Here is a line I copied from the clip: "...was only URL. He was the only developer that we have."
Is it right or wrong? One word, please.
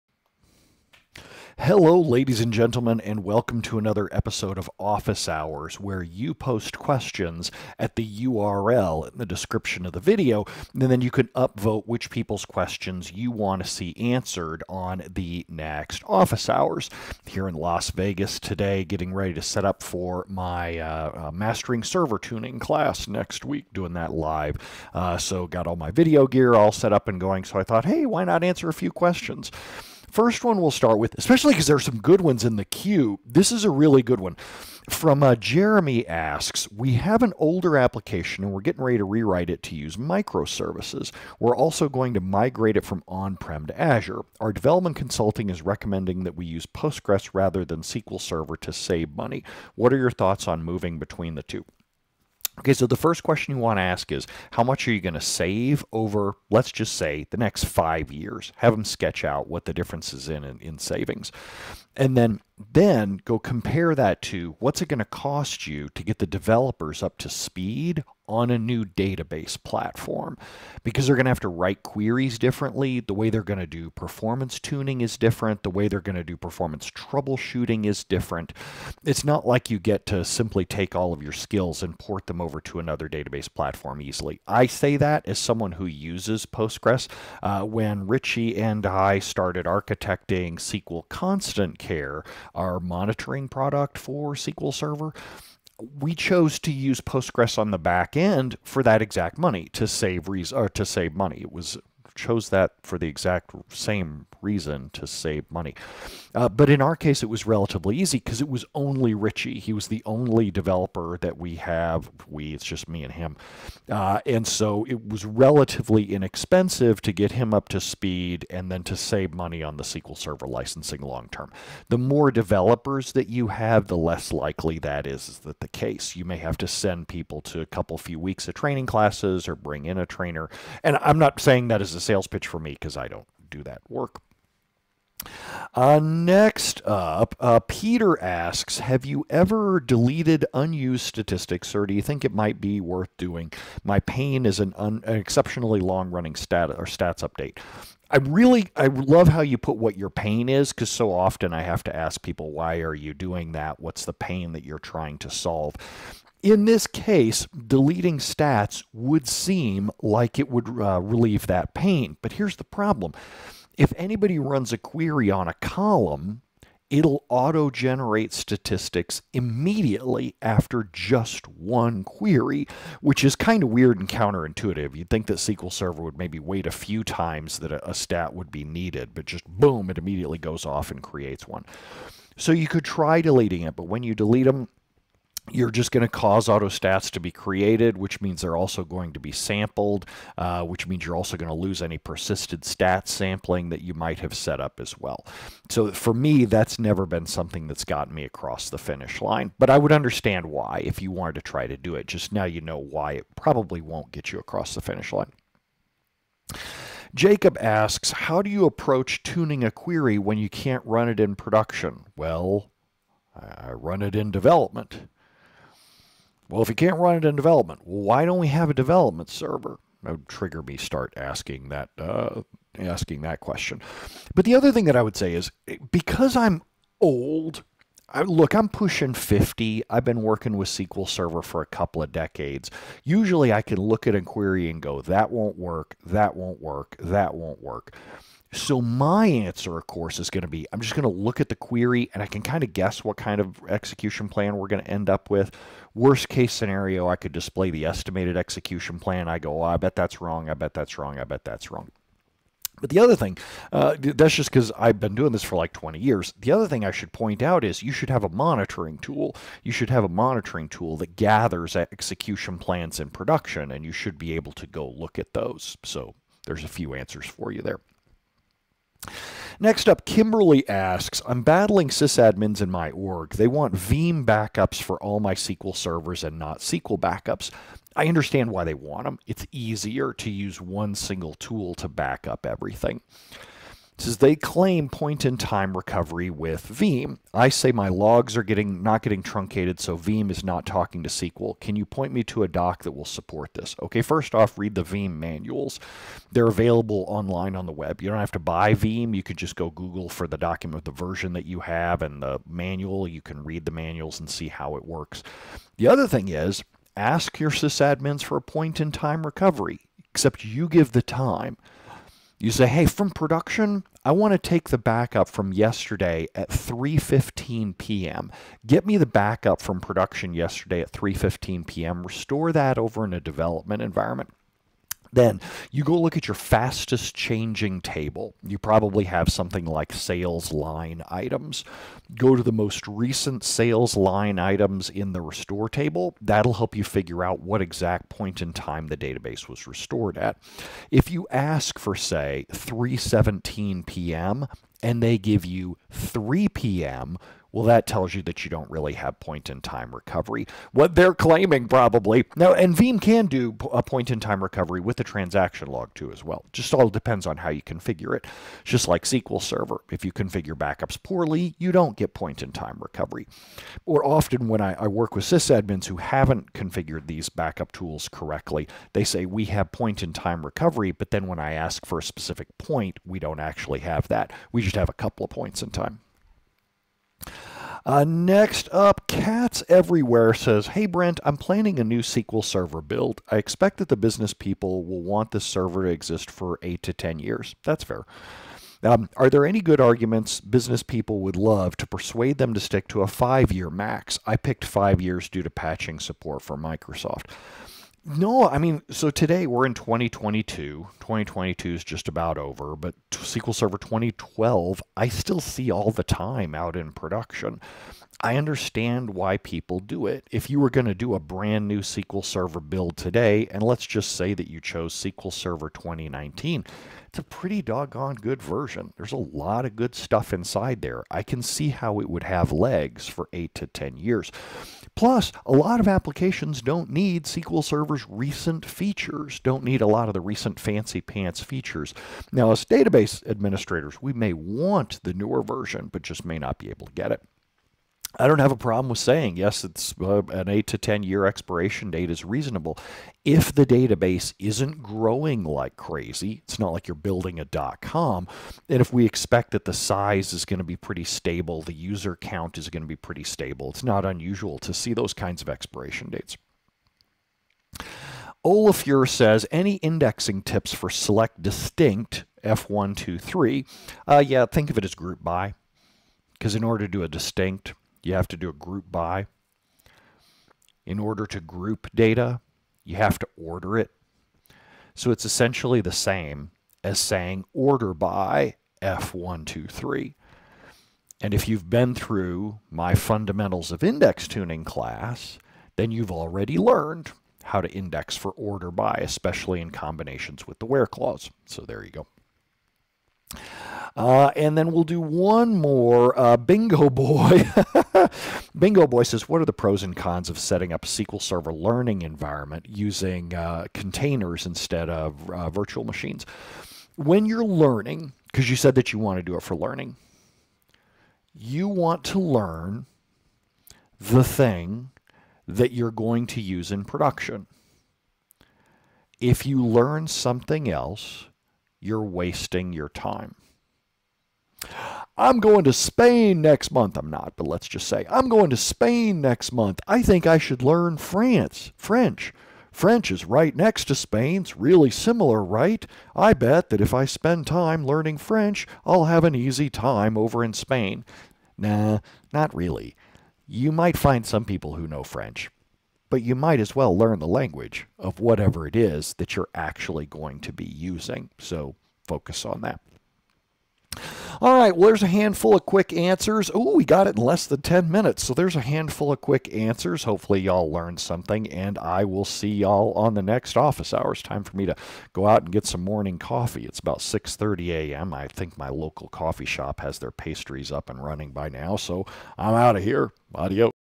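wrong.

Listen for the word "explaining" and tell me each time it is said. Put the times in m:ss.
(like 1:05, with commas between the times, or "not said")
not said.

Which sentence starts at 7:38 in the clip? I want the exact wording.
Olafur says, any indexing tips for select distinct F123?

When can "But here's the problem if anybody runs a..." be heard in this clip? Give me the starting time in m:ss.
2:42.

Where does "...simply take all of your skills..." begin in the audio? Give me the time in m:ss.
1:20.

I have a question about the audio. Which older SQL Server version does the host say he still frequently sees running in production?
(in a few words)
SQL Server 2012.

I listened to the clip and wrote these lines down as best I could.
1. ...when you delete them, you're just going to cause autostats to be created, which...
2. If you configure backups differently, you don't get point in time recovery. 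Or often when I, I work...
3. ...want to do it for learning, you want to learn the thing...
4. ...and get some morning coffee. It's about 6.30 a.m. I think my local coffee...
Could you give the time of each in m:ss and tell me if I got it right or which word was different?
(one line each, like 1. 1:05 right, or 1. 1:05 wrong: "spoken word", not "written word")
1. 3:03 right
2. 5:59 wrong: "poorly", not "differently"
3. 8:28 right
4. 9:25 right.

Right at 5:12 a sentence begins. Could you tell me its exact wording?
You say, hey, from production, I want to take the backup from yesterday at 3:15 p.m.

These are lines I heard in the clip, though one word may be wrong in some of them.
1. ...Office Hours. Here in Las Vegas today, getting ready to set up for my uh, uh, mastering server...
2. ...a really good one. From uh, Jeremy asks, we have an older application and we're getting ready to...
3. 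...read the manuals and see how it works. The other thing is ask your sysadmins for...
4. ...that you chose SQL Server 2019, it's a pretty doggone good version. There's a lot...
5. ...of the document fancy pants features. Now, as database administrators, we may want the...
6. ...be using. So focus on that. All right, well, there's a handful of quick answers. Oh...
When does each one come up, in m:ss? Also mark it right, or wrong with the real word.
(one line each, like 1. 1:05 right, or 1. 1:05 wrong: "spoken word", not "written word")
1. 0:16 right
2. 0:33 right
3. 5:03 right
4. 6:54 right
5. 7:10 wrong: "recent", not "document"
6. 9:10 right.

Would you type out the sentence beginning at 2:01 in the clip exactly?
The more developers that you have, the less likely that is, is that the case.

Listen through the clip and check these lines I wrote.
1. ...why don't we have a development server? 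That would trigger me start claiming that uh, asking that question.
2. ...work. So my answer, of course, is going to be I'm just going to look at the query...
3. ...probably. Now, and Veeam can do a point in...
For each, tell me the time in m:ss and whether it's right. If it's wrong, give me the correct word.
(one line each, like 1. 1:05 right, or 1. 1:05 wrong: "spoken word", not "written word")
1. 3:37 wrong: "asking", not "claiming"
2. 3:57 right
3. 5:51 right.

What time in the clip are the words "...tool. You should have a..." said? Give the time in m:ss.
4:18.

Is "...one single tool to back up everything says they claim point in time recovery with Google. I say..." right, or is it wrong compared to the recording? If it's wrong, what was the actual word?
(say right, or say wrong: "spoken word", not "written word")
wrong: "Veeam", not "Google".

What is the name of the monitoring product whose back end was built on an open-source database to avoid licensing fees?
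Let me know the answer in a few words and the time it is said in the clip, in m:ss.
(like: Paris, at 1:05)
SQL Constant Care, at 1:30.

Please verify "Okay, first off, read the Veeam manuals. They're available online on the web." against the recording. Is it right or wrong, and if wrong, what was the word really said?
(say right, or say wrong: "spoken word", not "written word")
right.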